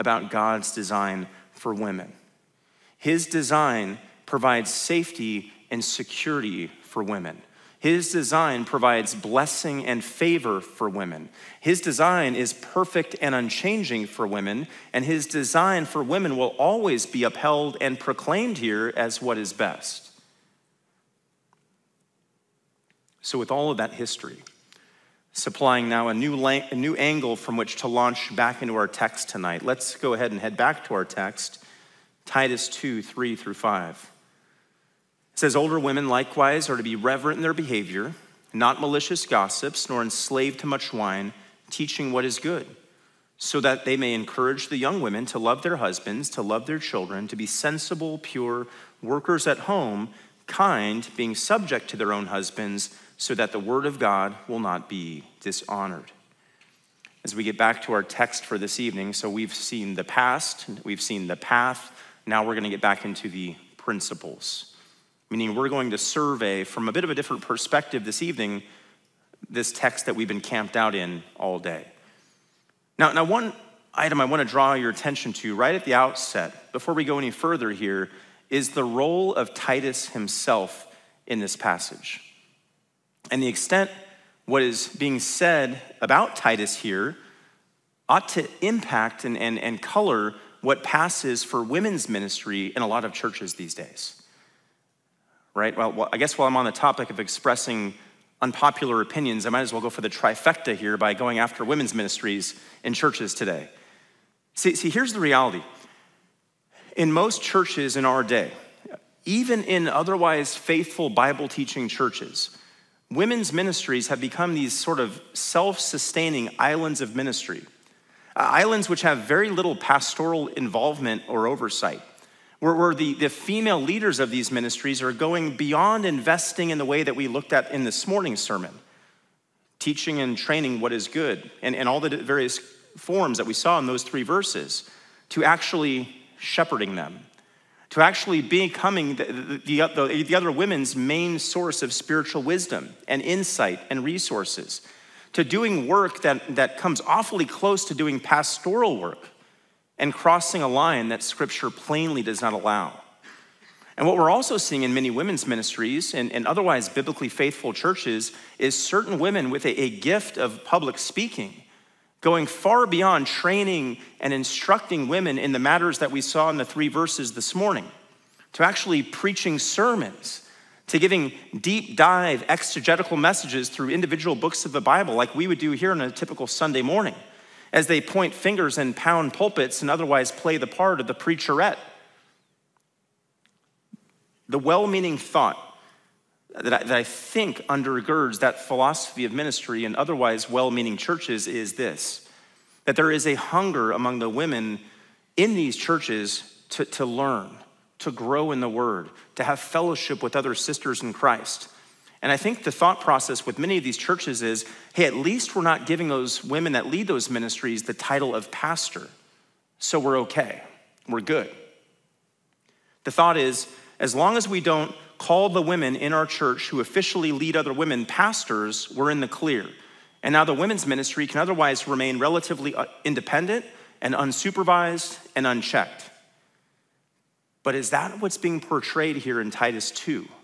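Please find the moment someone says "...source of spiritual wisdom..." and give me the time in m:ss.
2:21.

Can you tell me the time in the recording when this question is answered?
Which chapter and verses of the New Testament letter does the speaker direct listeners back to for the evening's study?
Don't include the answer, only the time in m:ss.
0:32.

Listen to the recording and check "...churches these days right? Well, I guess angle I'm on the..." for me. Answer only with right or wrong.
wrong.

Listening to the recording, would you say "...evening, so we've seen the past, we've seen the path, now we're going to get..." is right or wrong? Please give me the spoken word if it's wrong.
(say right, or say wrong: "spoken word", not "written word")
right.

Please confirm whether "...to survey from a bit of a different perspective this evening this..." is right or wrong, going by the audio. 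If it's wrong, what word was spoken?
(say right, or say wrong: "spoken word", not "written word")
right.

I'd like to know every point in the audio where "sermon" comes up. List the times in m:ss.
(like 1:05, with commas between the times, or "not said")
2:08, 2:49.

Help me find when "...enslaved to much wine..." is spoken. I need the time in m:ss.
0:40.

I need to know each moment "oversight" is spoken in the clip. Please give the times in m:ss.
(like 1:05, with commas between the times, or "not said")
2:01.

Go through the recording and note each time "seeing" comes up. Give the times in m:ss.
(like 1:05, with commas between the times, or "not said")
2:34.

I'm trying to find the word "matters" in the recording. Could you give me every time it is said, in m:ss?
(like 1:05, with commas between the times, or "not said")
2:45.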